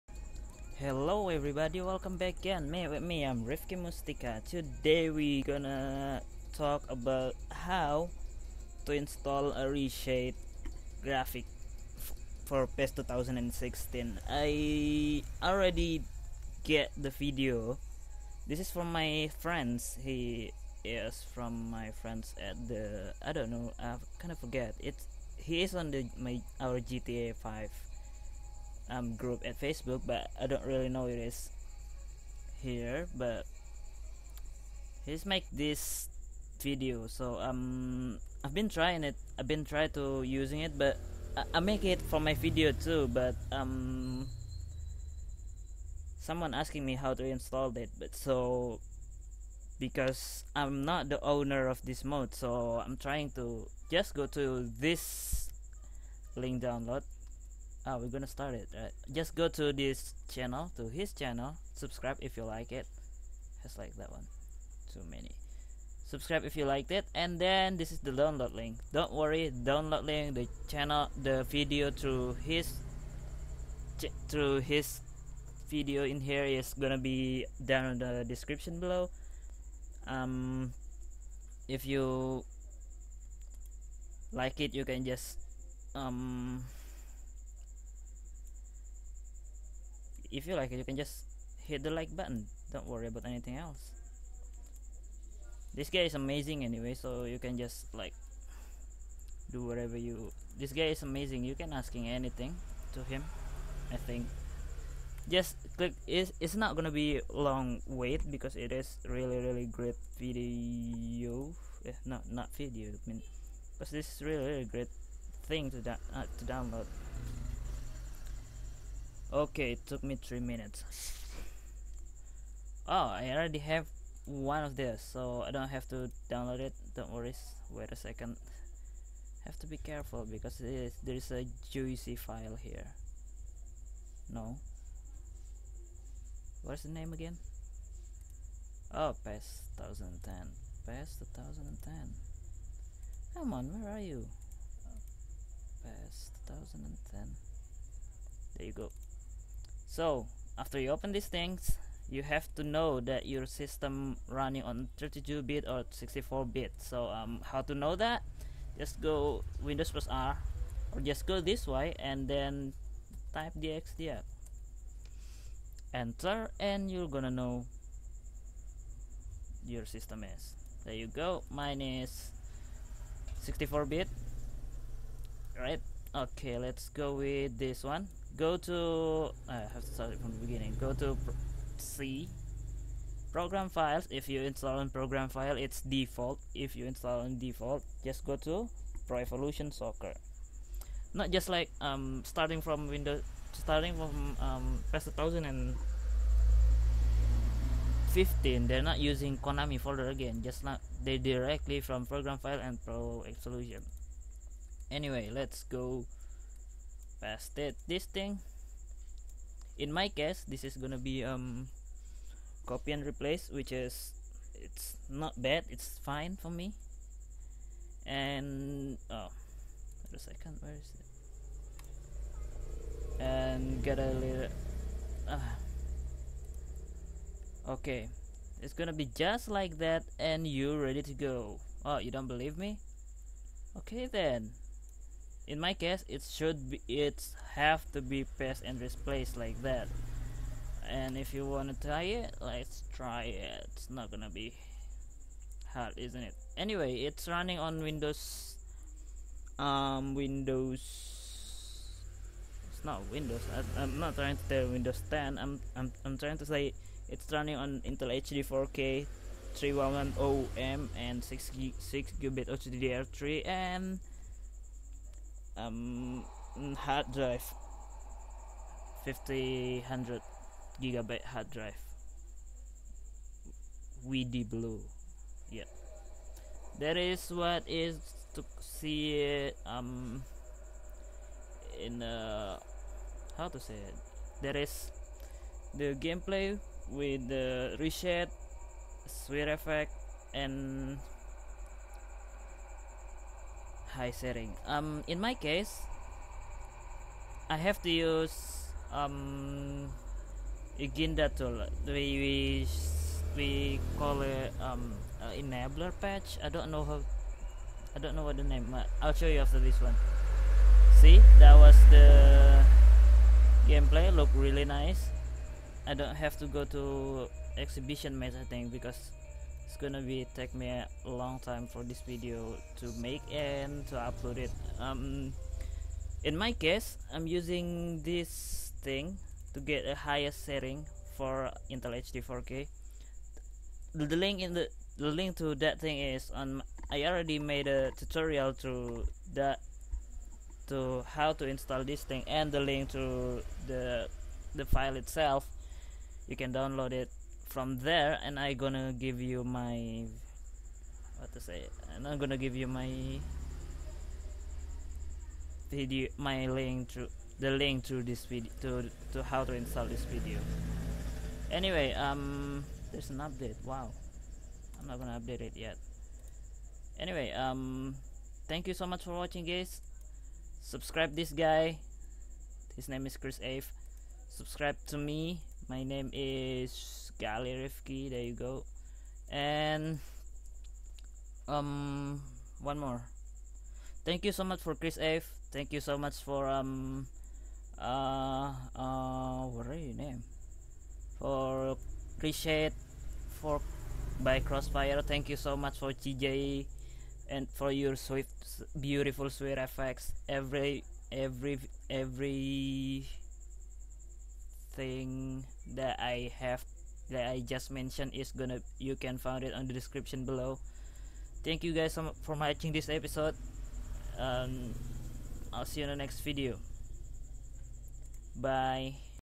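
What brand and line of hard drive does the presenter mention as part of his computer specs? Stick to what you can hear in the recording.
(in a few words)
WD Blue.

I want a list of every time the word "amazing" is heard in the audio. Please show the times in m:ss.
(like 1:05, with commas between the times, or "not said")
1:36, 1:41.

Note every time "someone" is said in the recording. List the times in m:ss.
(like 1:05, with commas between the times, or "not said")
0:46.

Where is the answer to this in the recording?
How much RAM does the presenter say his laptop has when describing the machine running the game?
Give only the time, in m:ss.
4:21.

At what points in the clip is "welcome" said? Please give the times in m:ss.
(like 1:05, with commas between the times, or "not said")
0:01.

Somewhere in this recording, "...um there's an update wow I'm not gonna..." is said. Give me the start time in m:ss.
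6:01.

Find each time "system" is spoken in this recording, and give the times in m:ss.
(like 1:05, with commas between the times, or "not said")
2:33, 2:49.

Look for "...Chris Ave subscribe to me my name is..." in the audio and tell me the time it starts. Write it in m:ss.
6:13.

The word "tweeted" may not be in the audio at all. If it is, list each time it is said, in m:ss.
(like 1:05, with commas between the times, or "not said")
not said.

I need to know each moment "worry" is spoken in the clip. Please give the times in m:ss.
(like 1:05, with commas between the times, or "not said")
1:09, 1:32, 2:07.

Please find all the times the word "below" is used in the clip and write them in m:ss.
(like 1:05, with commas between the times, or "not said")
1:18, 6:50.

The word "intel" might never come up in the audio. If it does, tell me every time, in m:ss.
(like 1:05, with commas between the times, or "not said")
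4:17, 5:31.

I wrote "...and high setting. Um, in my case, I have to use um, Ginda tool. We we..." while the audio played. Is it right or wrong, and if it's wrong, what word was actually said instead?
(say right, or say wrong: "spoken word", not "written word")
right.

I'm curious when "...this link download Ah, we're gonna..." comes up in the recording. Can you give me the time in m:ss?
0:54.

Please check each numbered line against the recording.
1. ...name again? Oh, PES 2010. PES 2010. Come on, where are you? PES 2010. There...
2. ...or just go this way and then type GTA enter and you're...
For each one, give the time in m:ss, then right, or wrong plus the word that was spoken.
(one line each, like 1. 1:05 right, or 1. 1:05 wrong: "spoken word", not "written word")
1. 2:16 right
2. 2:40 wrong: "DxDiag", not "GTA".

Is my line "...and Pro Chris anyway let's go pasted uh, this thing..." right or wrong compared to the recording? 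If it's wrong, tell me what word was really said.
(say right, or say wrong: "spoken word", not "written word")
wrong: "Evolution", not "Chris".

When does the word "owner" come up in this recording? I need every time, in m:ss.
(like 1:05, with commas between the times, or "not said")
0:51.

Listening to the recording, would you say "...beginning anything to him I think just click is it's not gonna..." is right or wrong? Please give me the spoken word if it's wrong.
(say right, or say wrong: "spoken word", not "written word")
wrong: "asking", not "beginning".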